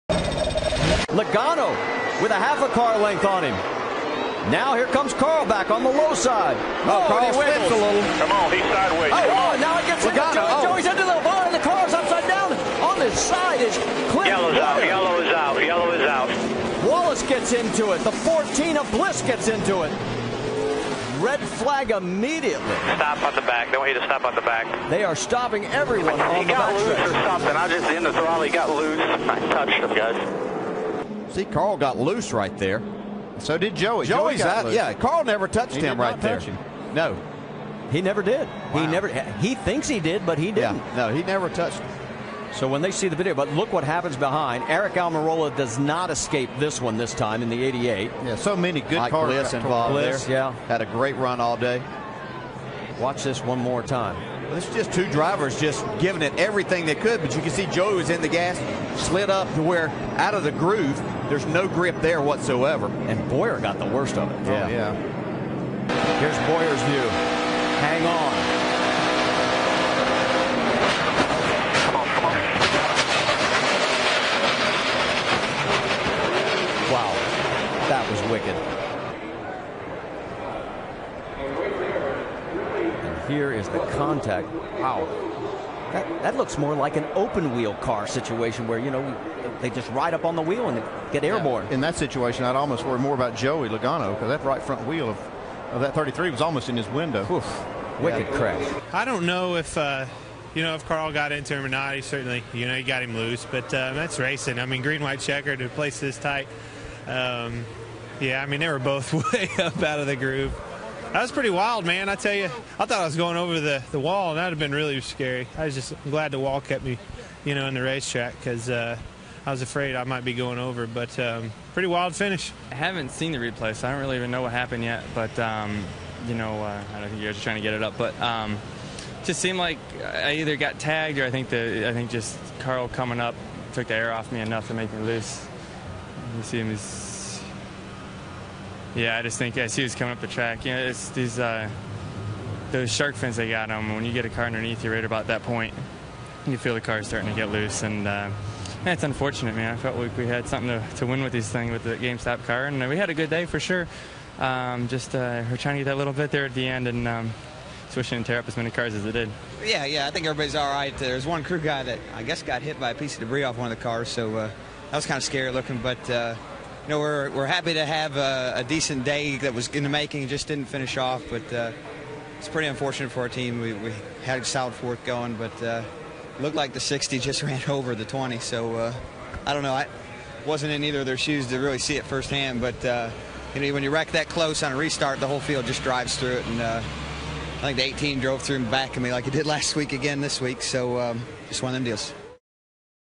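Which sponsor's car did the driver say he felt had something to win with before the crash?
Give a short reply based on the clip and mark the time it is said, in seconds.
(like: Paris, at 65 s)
GameStop, at 151 s.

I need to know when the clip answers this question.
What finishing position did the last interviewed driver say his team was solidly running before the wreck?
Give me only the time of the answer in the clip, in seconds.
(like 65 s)
174 s.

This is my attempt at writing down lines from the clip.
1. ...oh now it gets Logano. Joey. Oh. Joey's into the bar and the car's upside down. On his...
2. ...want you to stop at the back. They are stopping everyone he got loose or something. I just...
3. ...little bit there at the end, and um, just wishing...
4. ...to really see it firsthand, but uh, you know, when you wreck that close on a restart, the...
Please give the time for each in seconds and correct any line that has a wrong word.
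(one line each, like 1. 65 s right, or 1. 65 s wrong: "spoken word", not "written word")
1. 9 s right
2. 23 s right
3. 155 s right
4. 181 s right.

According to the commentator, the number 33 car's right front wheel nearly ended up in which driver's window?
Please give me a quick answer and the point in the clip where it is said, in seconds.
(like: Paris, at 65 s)
Joey Logano, at 93 s.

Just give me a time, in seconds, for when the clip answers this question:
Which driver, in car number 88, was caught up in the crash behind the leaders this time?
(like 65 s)
44 s.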